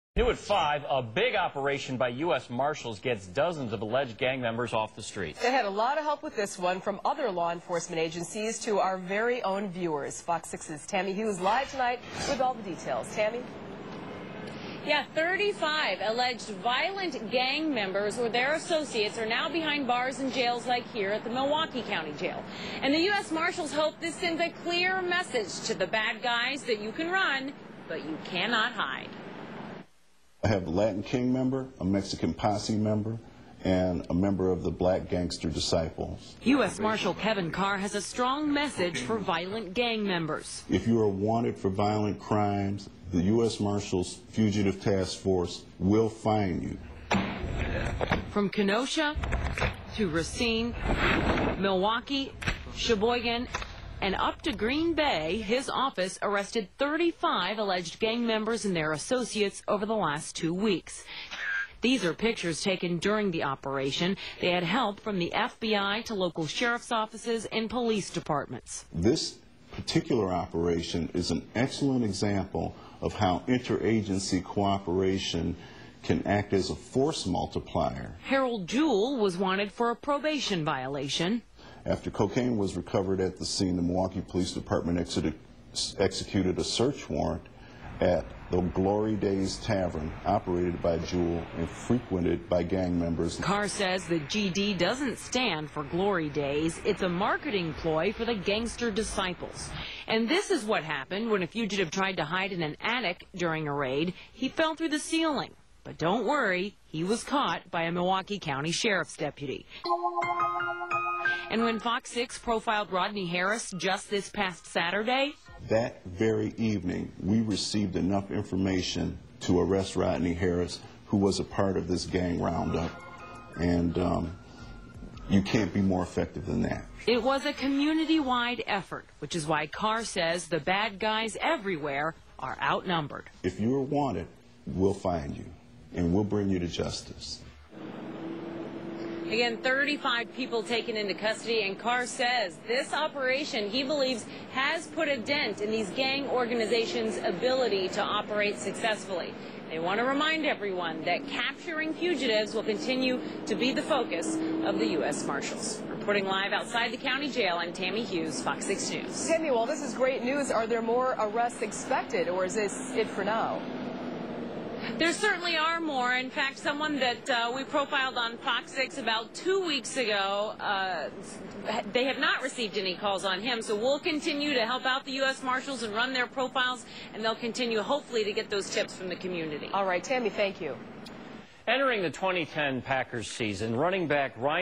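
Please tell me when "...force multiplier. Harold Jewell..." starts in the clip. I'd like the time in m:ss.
1:16.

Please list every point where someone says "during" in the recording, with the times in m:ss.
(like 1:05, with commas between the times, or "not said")
1:02, 1:43.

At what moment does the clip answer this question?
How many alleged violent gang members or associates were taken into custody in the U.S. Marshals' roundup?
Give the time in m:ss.
0:15.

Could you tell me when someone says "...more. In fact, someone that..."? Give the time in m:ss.
2:45.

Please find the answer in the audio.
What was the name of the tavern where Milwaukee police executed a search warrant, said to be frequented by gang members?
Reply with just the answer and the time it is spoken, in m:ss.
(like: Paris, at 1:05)
Glory Days Tavern, at 1:28.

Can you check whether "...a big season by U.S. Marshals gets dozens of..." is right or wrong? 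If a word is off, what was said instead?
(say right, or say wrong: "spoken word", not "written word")
wrong: "operation", not "season".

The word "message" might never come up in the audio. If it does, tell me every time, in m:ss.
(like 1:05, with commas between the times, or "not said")
0:25, 0:38.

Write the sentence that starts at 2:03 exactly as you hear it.
And um, you can't be more effective than that.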